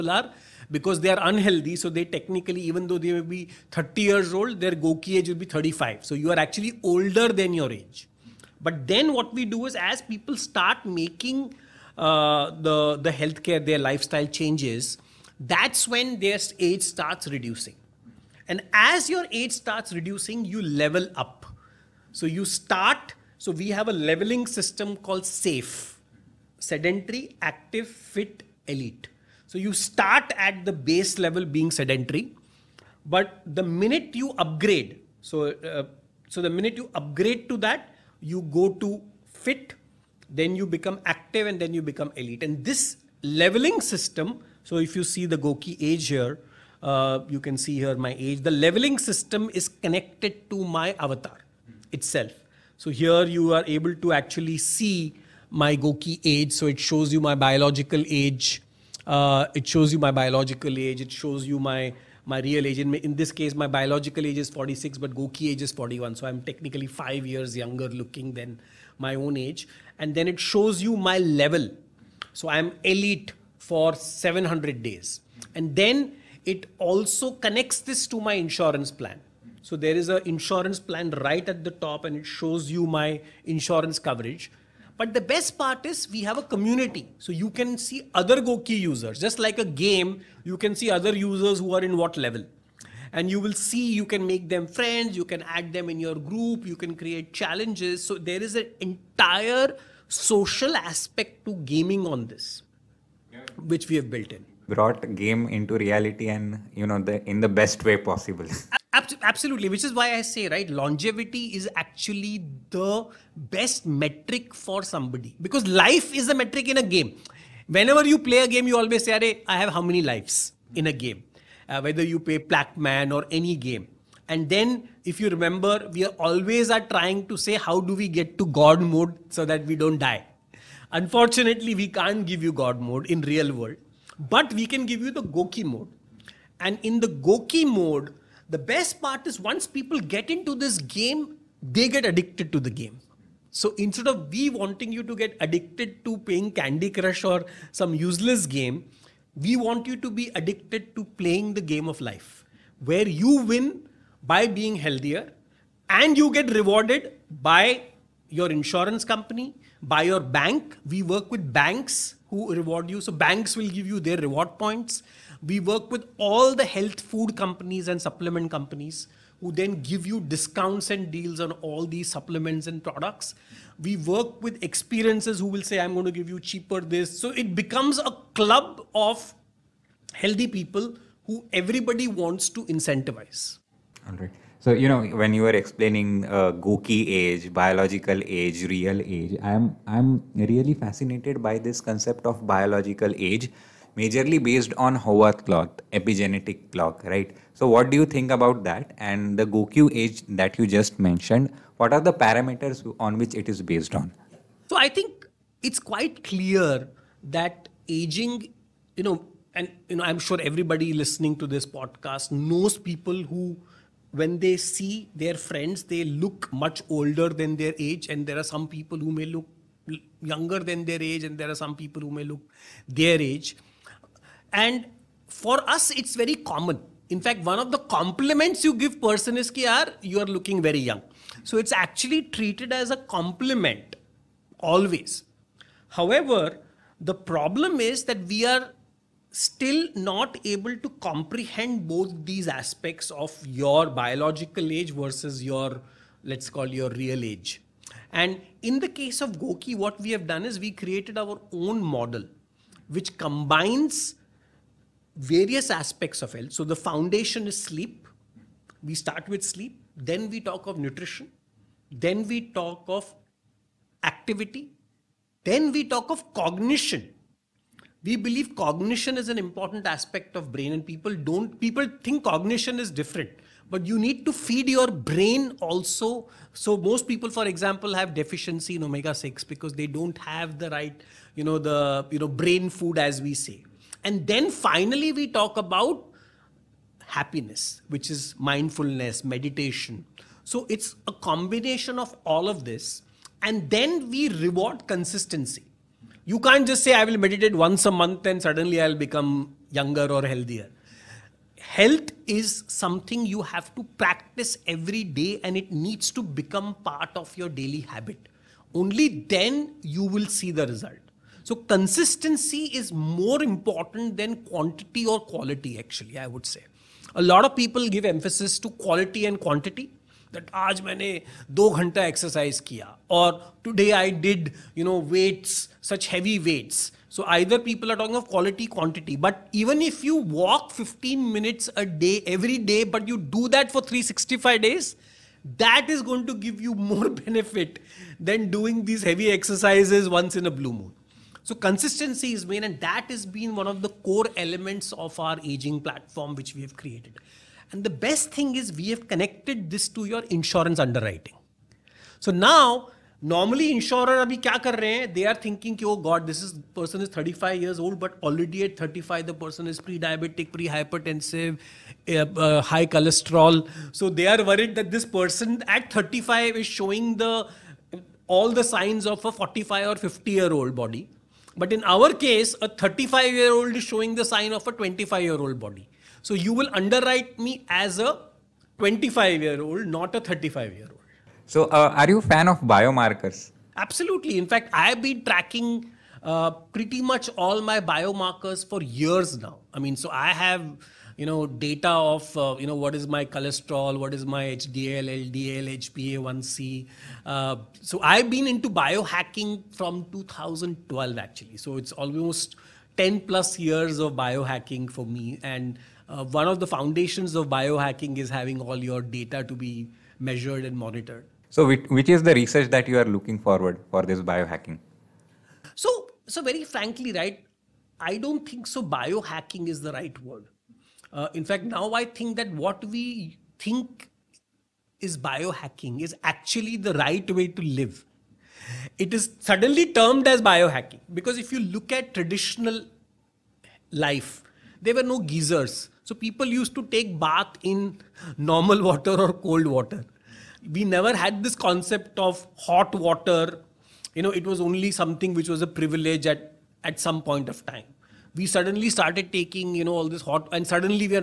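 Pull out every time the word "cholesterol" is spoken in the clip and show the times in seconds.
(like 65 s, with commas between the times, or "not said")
362 s, 393 s.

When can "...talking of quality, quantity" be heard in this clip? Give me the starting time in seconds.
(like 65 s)
327 s.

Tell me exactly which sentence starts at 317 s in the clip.
A lot of people give emphasis to quality and quantity.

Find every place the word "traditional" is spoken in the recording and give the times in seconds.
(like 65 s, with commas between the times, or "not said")
432 s.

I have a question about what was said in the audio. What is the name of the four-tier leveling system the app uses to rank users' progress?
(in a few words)
SAFE.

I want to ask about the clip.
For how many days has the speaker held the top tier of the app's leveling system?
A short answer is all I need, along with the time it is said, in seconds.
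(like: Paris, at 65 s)
700, at 73 s.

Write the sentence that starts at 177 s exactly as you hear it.
So it becomes a club of healthy people who everybody wants to incentivize.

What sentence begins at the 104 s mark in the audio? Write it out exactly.
Brought game into reality and, you know, the, in the best way possible.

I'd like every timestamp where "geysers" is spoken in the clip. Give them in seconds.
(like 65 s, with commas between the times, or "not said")
435 s.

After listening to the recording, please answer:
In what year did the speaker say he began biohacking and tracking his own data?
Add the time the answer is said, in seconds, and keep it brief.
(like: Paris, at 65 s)
2012, at 400 s.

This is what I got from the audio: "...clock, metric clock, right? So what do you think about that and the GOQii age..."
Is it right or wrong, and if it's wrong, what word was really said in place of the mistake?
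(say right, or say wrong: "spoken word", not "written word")
wrong: "epigenetic", not "metric".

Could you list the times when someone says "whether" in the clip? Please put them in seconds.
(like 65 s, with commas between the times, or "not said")
121 s.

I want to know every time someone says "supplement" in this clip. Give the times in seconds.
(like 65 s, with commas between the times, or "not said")
168 s, 172 s.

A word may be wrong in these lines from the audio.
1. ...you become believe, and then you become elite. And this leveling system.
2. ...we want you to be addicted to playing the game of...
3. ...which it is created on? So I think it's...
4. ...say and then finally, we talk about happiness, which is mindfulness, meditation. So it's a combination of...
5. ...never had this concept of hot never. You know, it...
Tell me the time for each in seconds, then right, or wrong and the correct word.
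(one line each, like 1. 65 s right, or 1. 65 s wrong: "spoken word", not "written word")
1. 40 s wrong: "active", not "believe"
2. 149 s right
3. 203 s wrong: "based", not "created"
4. 283 s right
5. 440 s wrong: "water", not "never".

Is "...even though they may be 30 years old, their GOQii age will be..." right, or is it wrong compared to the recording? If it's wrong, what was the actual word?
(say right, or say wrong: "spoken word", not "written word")
right.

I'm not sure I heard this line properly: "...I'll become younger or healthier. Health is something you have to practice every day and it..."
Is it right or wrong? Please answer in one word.
right.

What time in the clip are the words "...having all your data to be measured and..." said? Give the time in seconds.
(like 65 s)
408 s.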